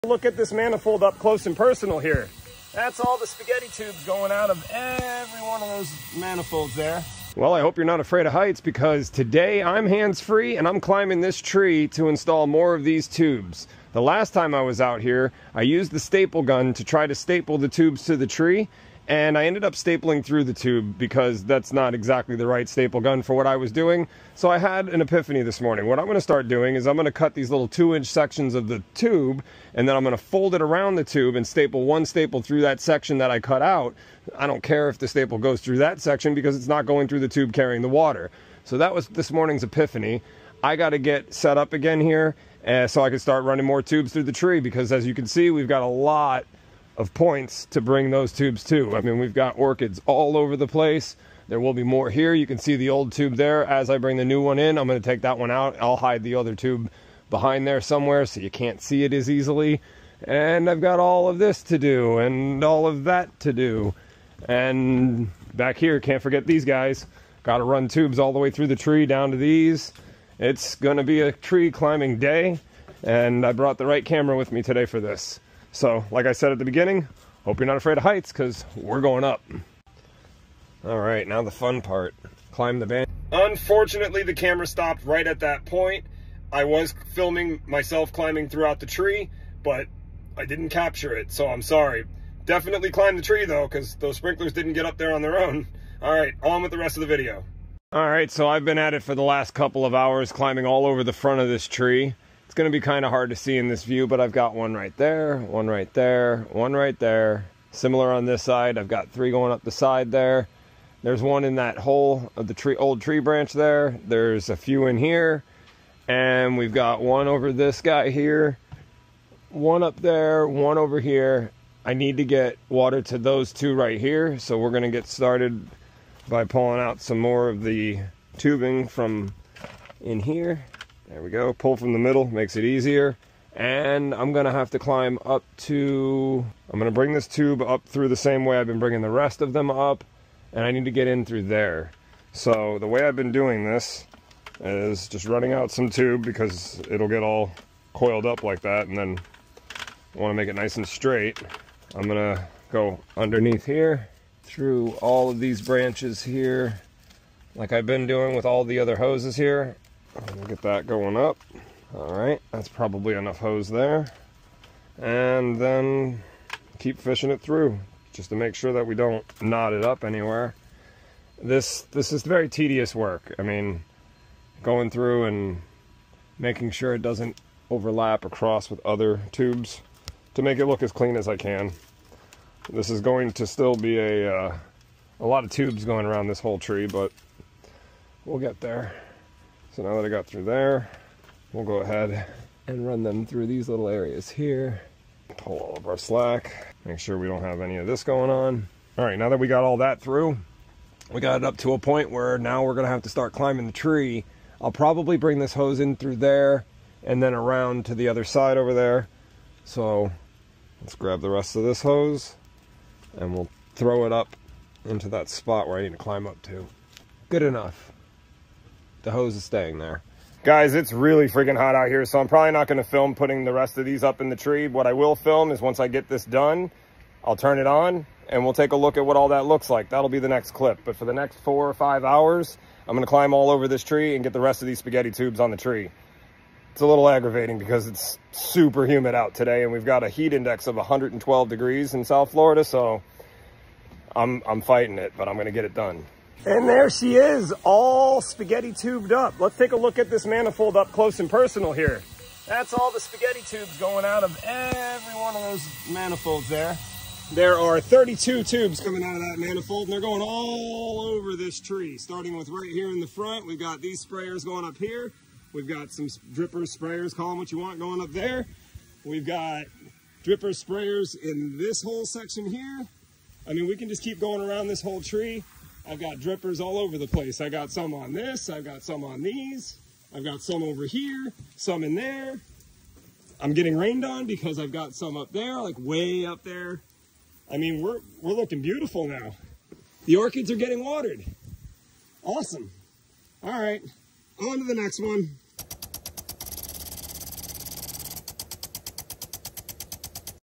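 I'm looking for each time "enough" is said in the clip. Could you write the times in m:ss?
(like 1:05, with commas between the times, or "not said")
2:43, 3:37.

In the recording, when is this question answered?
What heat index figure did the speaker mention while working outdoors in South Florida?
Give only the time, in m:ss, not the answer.
4:00.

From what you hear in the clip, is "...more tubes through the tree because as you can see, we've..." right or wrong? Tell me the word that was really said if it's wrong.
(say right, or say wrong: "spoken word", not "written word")
right.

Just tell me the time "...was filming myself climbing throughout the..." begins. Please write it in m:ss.
1:26.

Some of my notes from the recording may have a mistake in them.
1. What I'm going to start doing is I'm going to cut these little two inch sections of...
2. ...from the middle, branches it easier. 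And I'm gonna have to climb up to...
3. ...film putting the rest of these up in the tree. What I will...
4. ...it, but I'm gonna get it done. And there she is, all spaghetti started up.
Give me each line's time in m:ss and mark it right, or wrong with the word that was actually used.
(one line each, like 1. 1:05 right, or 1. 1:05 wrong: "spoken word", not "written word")
1. 0:25 right
2. 2:11 wrong: "makes", not "branches"
3. 3:42 right
4. 4:04 wrong: "tubed", not "started".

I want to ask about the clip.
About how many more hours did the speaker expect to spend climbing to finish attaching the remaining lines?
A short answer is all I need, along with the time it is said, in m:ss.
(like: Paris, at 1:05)
4 or 5 hours, at 3:51.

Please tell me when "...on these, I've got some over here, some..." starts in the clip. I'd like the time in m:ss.
4:39.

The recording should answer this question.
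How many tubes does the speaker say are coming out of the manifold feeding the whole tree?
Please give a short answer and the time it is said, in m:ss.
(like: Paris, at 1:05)
32, at 4:17.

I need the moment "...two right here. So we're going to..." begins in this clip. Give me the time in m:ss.
2:03.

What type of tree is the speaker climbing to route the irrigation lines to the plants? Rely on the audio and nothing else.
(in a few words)
Banyan.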